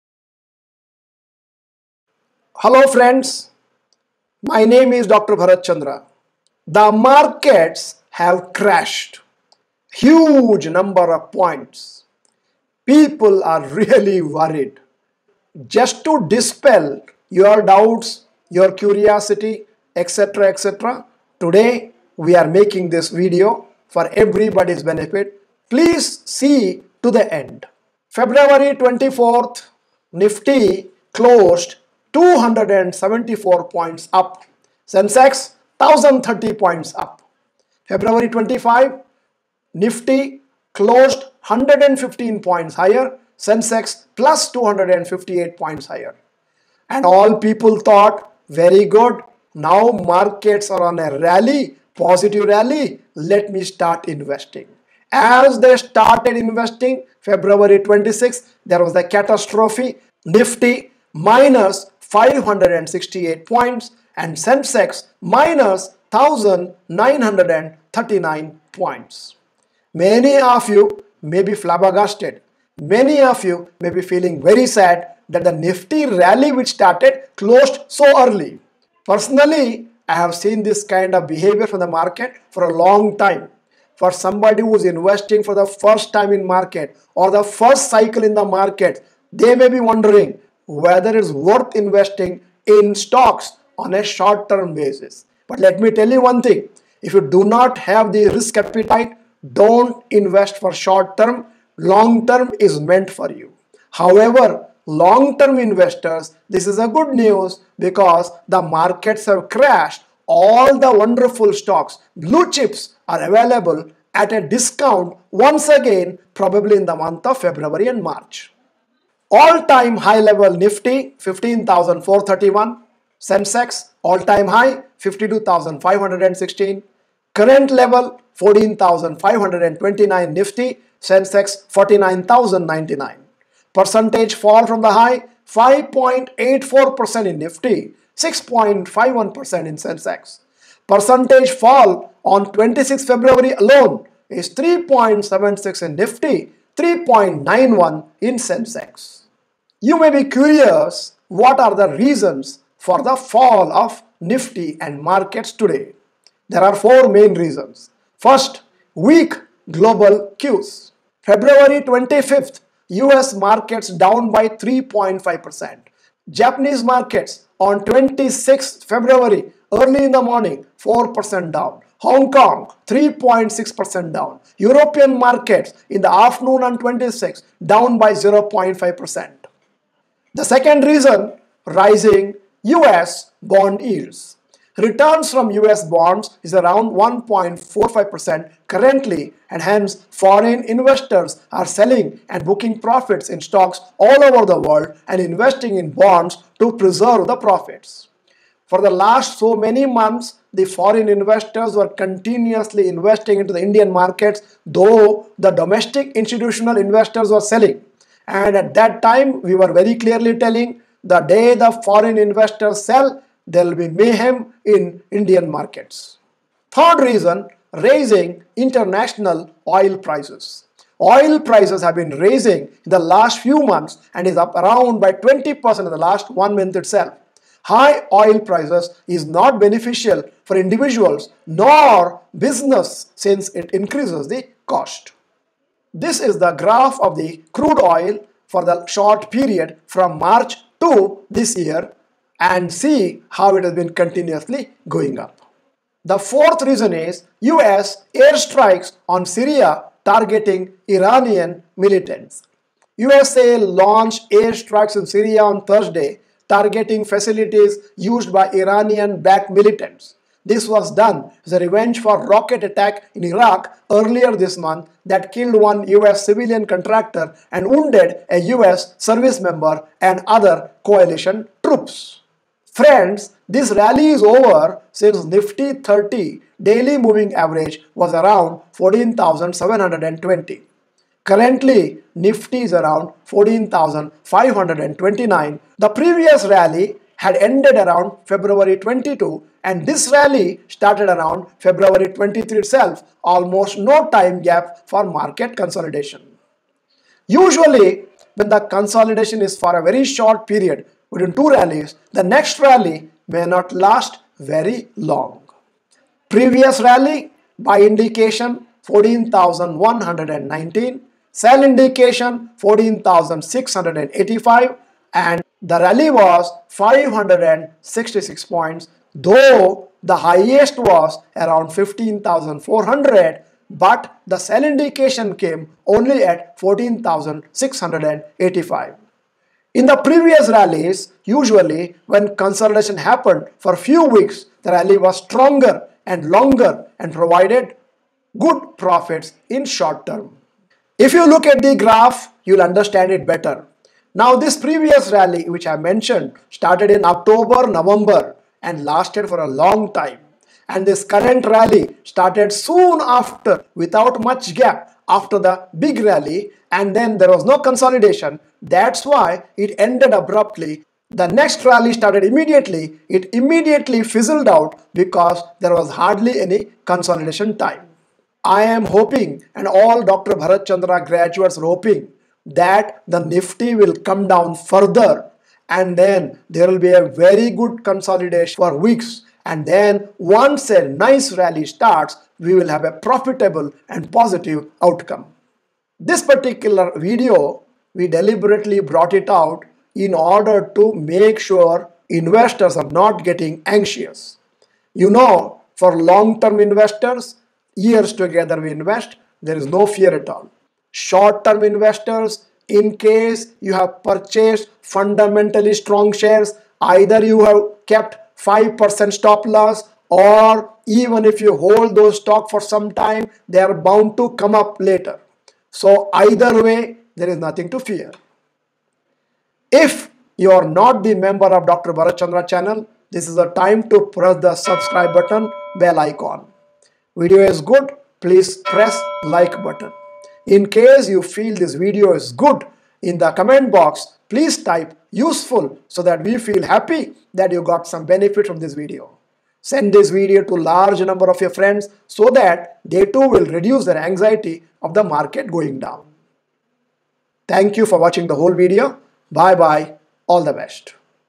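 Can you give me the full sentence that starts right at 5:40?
If you look at the graph, you'll understand it better.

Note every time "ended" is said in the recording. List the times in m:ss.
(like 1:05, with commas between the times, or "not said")
4:47, 5:59.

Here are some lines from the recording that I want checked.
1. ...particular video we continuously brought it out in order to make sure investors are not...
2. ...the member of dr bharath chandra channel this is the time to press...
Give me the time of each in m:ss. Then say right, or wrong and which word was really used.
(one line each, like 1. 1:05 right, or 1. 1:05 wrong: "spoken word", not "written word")
1. 6:26 wrong: "deliberately", not "continuously"
2. 7:01 right.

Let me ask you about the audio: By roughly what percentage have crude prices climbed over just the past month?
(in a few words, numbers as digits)
20%.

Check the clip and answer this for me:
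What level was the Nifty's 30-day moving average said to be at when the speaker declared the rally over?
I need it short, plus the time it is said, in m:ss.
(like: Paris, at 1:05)
14,720, at 4:38.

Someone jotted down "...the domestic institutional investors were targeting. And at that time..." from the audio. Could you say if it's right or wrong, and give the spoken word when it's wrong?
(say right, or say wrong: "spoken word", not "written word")
wrong: "selling", not "targeting".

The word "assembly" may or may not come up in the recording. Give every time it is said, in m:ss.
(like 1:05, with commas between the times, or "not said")
not said.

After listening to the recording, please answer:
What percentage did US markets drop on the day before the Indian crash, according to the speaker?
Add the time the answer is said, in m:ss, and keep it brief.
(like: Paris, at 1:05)
3.5%, at 2:44.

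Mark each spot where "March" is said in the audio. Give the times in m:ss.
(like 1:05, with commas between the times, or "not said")
1:58, 4:00.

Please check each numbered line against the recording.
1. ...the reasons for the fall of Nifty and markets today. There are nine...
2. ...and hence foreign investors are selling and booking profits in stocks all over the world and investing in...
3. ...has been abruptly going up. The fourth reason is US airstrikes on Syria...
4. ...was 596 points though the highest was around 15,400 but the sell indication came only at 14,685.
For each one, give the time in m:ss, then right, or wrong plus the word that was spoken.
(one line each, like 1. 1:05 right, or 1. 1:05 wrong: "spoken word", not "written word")
1. 2:31 wrong: "four", not "nine"
2. 3:09 right
3. 4:03 wrong: "continuously", not "abruptly"
4. 5:16 wrong: "566", not "596".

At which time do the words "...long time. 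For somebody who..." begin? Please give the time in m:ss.
1:22.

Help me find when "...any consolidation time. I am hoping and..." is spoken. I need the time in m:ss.
6:06.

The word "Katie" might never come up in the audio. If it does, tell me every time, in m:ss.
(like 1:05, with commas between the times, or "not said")
not said.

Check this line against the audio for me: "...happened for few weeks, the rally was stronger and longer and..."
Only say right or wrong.
right.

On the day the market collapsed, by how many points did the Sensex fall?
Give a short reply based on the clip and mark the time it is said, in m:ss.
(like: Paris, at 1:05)
1939 points, at 1:06.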